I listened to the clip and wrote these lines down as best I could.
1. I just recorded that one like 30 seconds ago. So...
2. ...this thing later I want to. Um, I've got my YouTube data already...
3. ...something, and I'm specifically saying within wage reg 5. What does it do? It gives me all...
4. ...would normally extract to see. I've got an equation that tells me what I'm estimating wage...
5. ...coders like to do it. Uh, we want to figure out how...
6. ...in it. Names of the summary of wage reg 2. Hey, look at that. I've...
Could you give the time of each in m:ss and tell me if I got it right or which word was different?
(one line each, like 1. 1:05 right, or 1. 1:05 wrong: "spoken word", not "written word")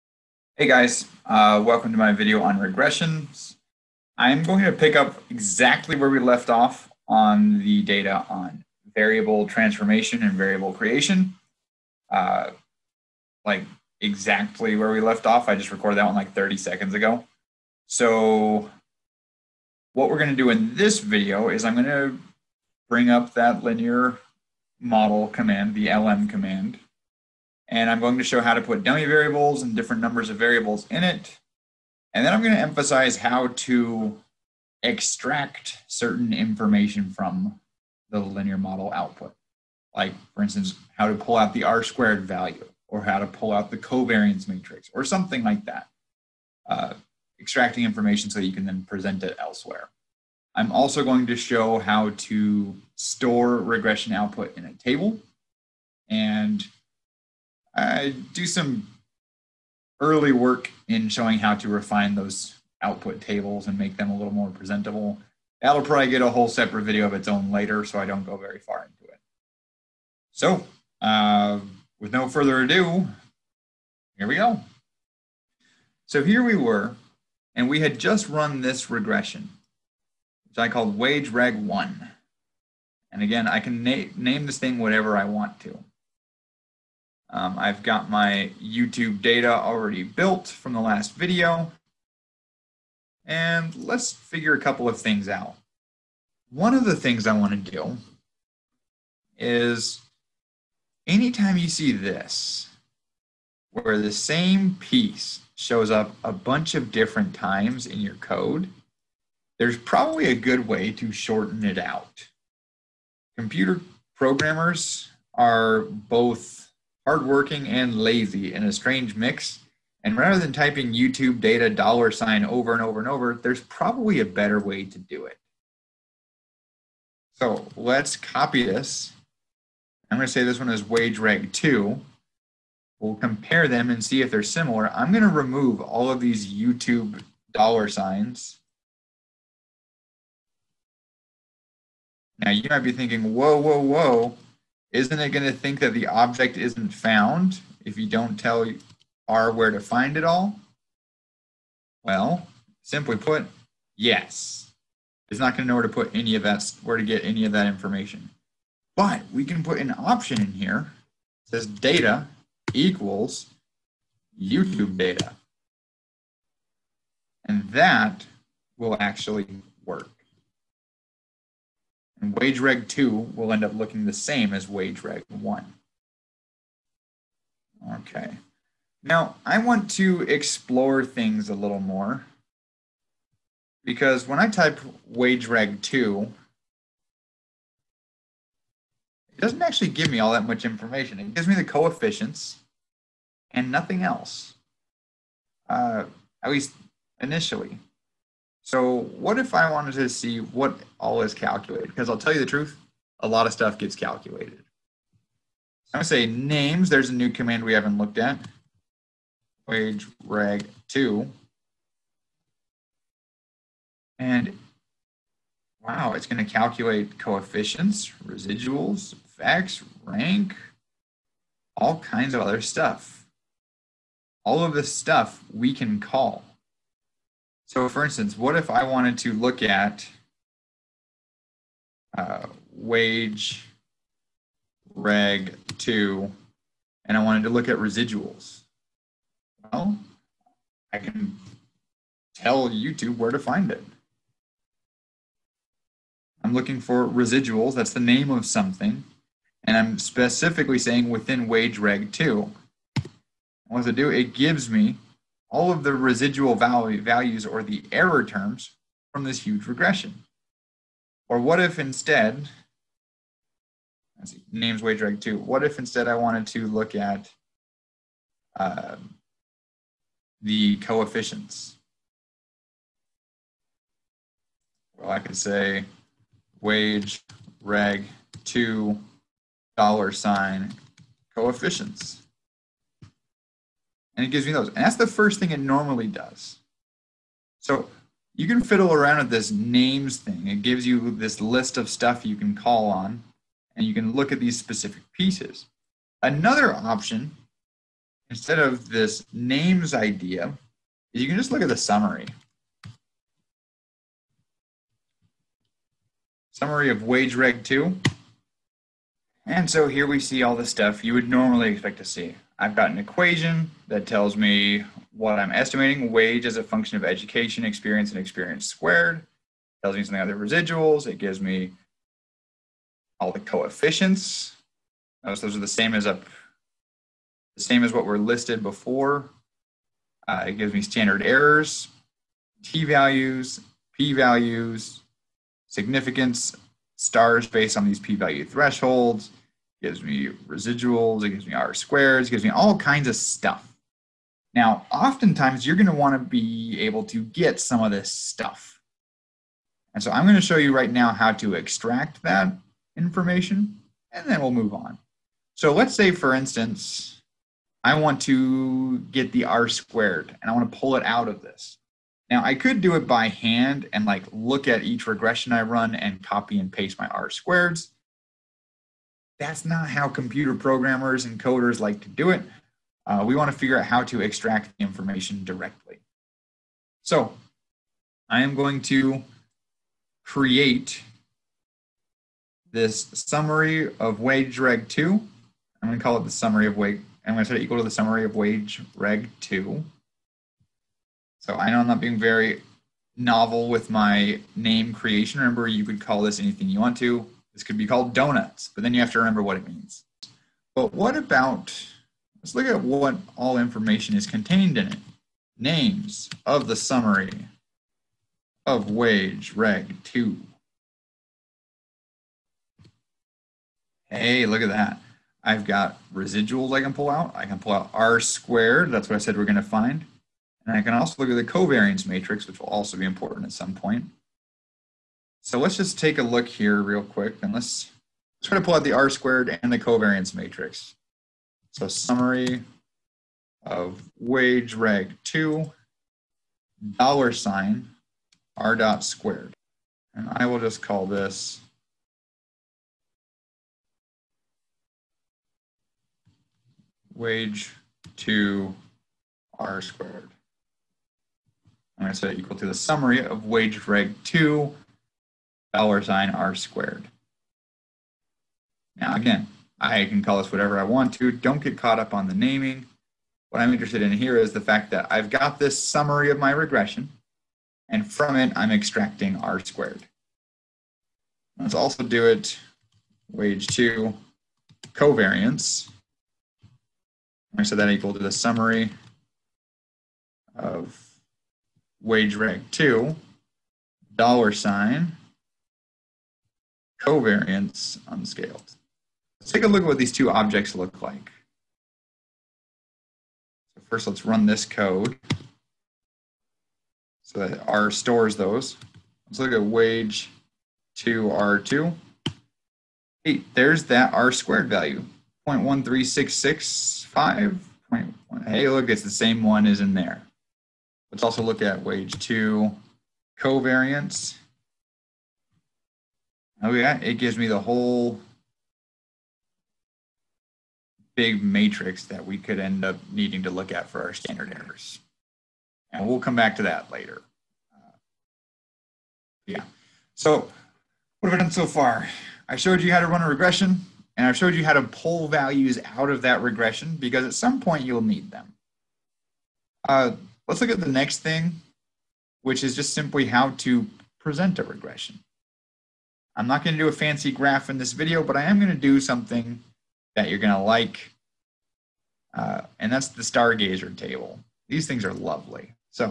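1. 0:15 right
2. 1:24 wrong: "whatever", not "later"
3. 4:08 wrong: "2", not "5"
4. 5:11 wrong: "expect", not "extract"
5. 6:11 right
6. 6:44 right.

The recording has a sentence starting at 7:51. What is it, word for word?
Let's also do it wage two covariance.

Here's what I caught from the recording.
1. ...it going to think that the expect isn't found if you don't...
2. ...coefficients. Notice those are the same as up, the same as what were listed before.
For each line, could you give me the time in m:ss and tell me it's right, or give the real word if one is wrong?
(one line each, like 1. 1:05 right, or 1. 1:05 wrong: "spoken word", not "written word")
1. 2:25 wrong: "object", not "expect"
2. 5:23 right.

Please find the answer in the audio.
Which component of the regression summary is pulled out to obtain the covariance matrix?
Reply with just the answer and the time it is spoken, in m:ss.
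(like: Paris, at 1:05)
covariance unscaled, at 8:07.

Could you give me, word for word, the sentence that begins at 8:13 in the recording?
So first, let's run this code so that R stores those.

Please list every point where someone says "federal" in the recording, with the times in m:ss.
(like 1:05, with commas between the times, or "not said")
not said.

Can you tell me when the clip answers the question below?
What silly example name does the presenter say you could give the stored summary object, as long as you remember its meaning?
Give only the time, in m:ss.
6:38.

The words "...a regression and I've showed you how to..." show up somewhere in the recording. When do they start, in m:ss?
8:53.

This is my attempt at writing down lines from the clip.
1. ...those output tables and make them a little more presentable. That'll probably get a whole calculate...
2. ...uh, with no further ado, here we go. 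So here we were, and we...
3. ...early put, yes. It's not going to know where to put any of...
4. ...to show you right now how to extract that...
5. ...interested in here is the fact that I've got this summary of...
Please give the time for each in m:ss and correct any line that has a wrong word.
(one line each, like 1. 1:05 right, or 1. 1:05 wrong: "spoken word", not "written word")
1. 1:02 wrong: "separate", not "calculate"
2. 1:11 right
3. 2:32 wrong: "simply", not "early"
4. 5:50 right
5. 7:43 right.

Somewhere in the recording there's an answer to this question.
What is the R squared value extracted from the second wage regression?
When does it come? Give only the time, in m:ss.
8:25.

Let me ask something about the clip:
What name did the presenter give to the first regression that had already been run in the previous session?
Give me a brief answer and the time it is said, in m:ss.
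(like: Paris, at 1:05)
wage reg one, at 1:20.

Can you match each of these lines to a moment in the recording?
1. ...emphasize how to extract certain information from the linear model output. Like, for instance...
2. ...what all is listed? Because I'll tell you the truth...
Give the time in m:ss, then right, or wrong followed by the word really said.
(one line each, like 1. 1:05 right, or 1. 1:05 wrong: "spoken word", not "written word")
1. 0:32 right
2. 3:20 wrong: "calculated", not "listed".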